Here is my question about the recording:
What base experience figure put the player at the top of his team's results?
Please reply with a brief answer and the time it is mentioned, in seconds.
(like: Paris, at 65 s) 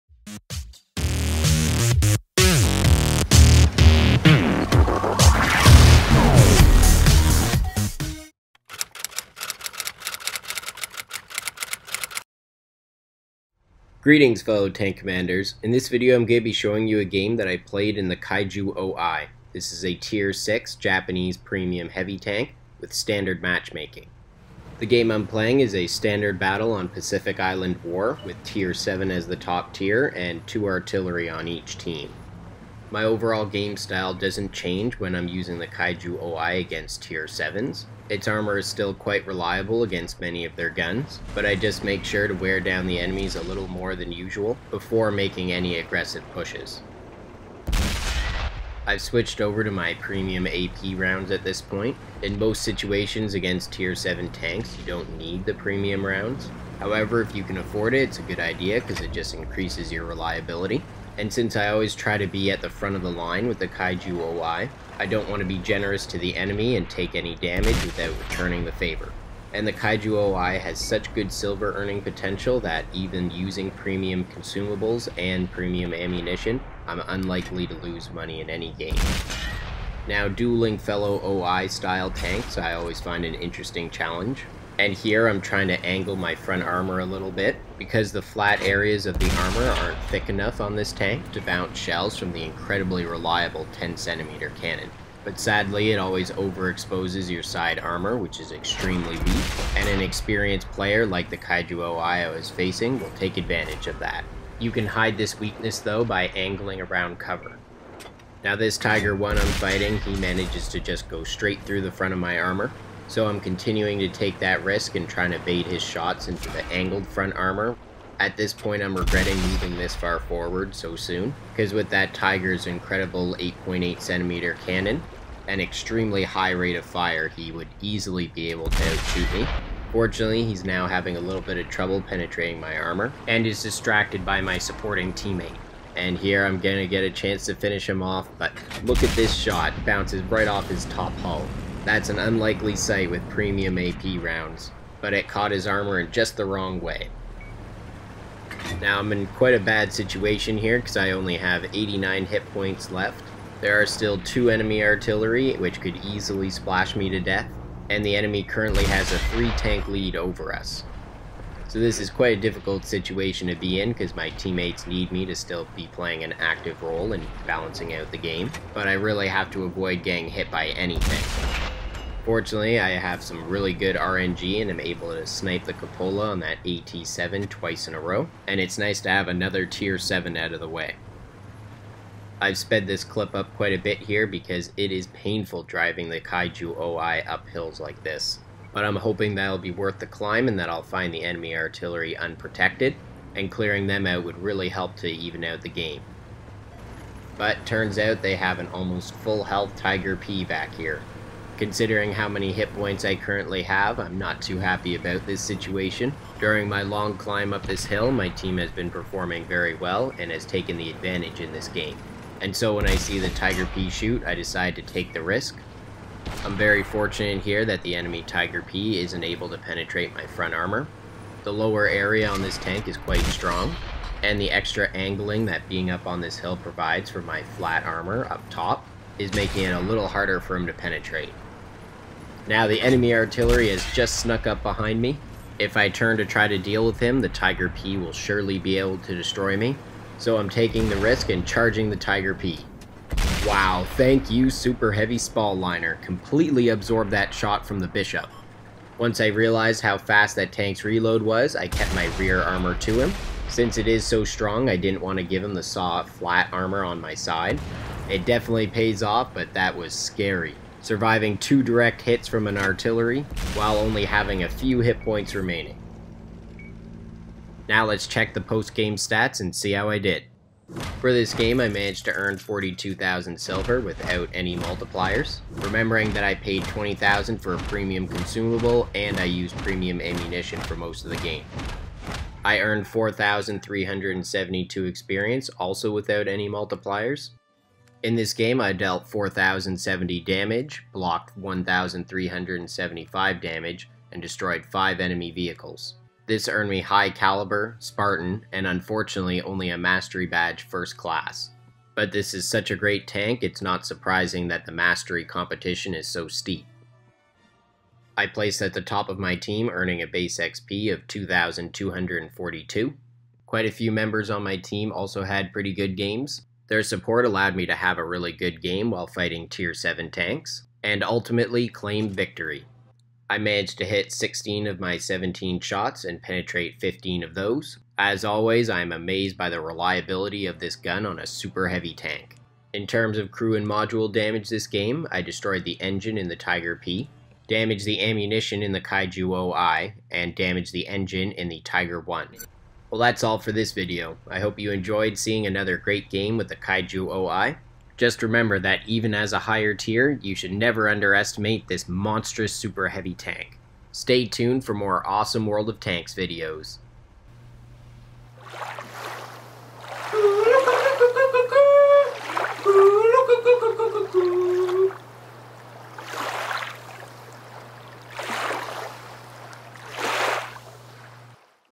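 2,242, at 311 s.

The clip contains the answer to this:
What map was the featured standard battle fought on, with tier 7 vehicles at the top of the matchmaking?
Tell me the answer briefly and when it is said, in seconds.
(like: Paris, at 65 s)
Pacific Island War, at 26 s.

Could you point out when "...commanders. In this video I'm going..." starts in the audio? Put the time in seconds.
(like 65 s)
14 s.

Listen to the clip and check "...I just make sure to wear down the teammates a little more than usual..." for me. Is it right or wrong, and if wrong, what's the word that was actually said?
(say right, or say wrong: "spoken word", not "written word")
wrong: "enemies", not "teammates".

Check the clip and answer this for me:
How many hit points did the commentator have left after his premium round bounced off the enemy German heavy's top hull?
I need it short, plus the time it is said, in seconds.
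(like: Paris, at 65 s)
89, at 151 s.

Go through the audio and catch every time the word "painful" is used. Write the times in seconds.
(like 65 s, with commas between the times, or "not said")
185 s.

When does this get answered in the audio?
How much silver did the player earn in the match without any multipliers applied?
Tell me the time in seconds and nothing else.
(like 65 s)
272 s.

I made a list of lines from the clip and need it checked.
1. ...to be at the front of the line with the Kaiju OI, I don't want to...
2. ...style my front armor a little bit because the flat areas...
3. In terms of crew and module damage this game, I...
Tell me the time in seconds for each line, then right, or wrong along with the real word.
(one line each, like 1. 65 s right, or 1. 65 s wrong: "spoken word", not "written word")
1. 62 s right
2. 85 s wrong: "angle", not "style"
3. 332 s right.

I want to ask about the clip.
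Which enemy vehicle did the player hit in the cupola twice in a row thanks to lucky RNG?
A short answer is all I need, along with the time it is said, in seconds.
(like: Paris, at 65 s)
AT7, at 176 s.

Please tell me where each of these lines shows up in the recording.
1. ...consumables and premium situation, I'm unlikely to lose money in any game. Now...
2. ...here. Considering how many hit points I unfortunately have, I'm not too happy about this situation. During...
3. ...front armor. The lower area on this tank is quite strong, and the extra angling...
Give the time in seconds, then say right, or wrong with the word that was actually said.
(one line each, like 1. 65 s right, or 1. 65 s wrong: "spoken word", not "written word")
1. 74 s wrong: "ammunition", not "situation"
2. 200 s wrong: "currently", not "unfortunately"
3. 220 s right.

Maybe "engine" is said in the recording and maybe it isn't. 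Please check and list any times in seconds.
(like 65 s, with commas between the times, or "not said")
335 s, 340 s.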